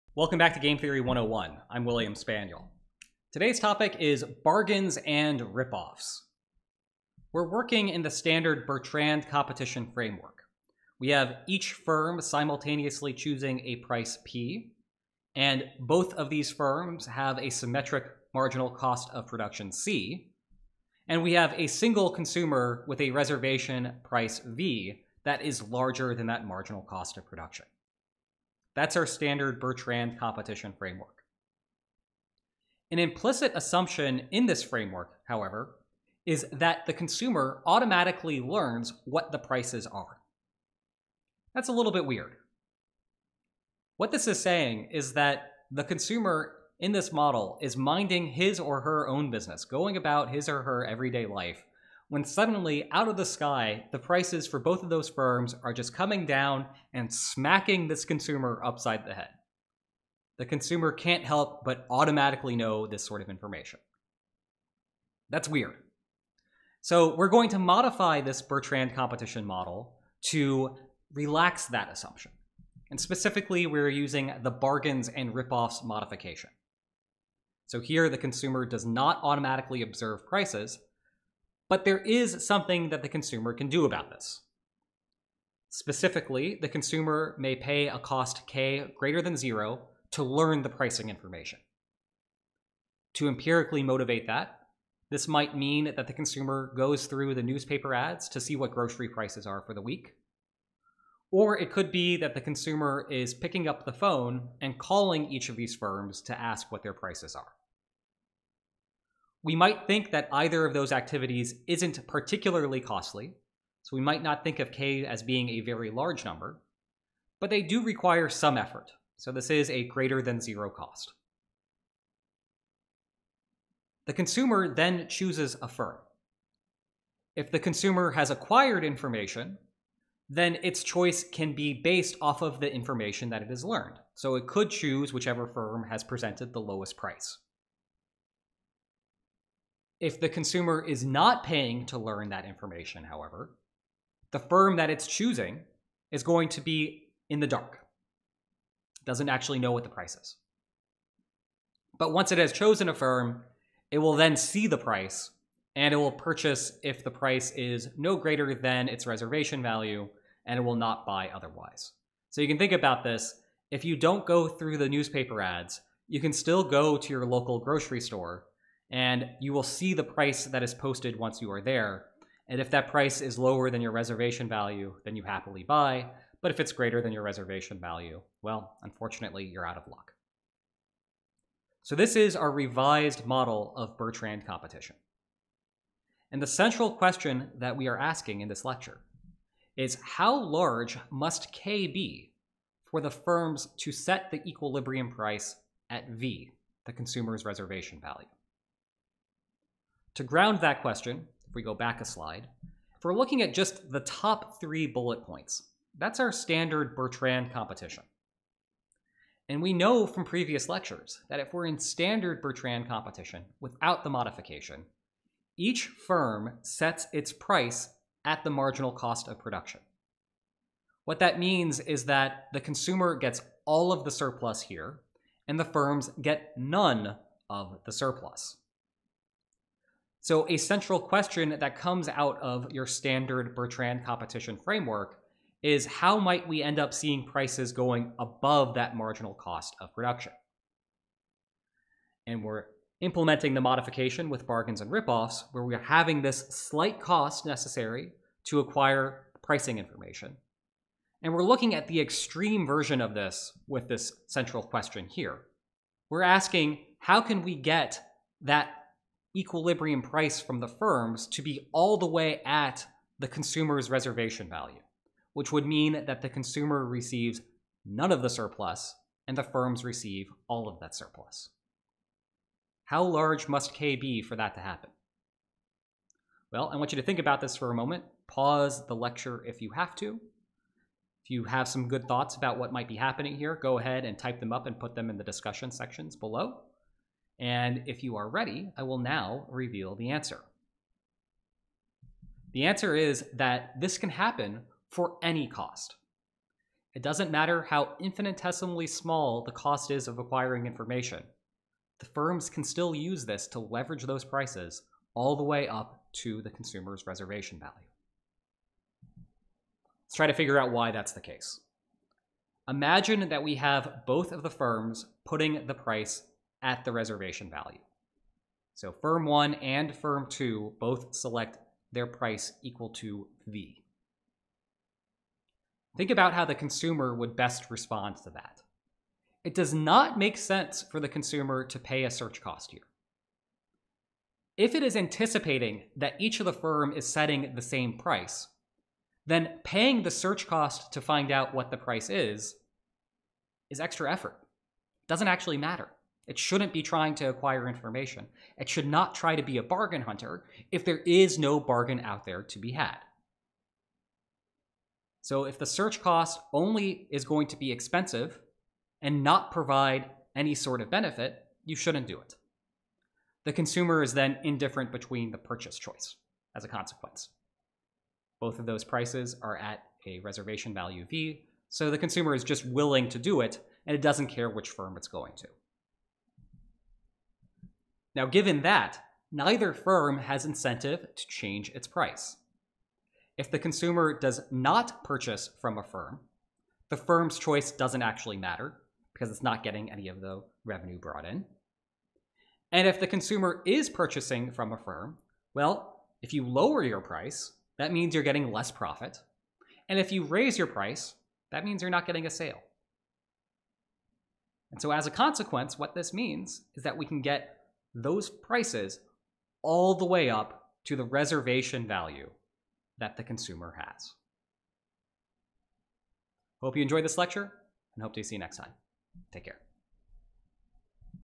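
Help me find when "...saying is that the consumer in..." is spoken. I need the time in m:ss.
0:44.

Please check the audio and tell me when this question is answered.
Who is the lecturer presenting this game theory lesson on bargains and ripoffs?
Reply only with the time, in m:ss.
0:01.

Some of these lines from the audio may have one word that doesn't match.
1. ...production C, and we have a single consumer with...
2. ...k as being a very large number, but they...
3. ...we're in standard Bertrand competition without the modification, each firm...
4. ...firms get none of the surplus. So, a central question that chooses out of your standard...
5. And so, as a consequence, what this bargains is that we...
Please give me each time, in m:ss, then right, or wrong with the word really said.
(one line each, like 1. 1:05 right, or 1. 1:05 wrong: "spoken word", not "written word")
1. 0:19 right
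2. 1:54 right
3. 3:31 right
4. 3:45 wrong: "comes", not "chooses"
5. 6:44 wrong: "means", not "bargains".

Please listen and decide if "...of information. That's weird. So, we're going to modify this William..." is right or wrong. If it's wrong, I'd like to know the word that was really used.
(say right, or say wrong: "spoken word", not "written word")
wrong: "Bertrand", not "William".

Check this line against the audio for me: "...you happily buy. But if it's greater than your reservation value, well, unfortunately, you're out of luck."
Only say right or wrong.
right.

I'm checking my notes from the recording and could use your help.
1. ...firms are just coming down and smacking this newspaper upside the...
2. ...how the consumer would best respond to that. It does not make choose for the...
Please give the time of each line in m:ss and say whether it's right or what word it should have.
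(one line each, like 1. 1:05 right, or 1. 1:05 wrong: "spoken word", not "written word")
1. 0:55 wrong: "consumer", not "newspaper"
2. 5:26 wrong: "sense", not "choose".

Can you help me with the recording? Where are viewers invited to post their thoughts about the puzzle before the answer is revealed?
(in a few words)
discussion sections.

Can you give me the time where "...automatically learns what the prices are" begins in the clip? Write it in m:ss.
0:37.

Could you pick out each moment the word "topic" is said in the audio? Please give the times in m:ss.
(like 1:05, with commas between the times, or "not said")
0:03.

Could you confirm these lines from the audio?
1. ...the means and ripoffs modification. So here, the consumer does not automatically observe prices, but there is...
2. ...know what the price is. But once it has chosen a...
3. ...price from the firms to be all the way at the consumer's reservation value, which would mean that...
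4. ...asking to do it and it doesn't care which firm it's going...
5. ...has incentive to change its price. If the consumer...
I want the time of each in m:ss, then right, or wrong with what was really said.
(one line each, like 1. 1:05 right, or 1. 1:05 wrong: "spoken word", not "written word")
1. 1:14 wrong: "bargains", not "means"
2. 2:29 right
3. 4:20 right
4. 6:12 wrong: "willing", not "asking"
5. 6:20 right.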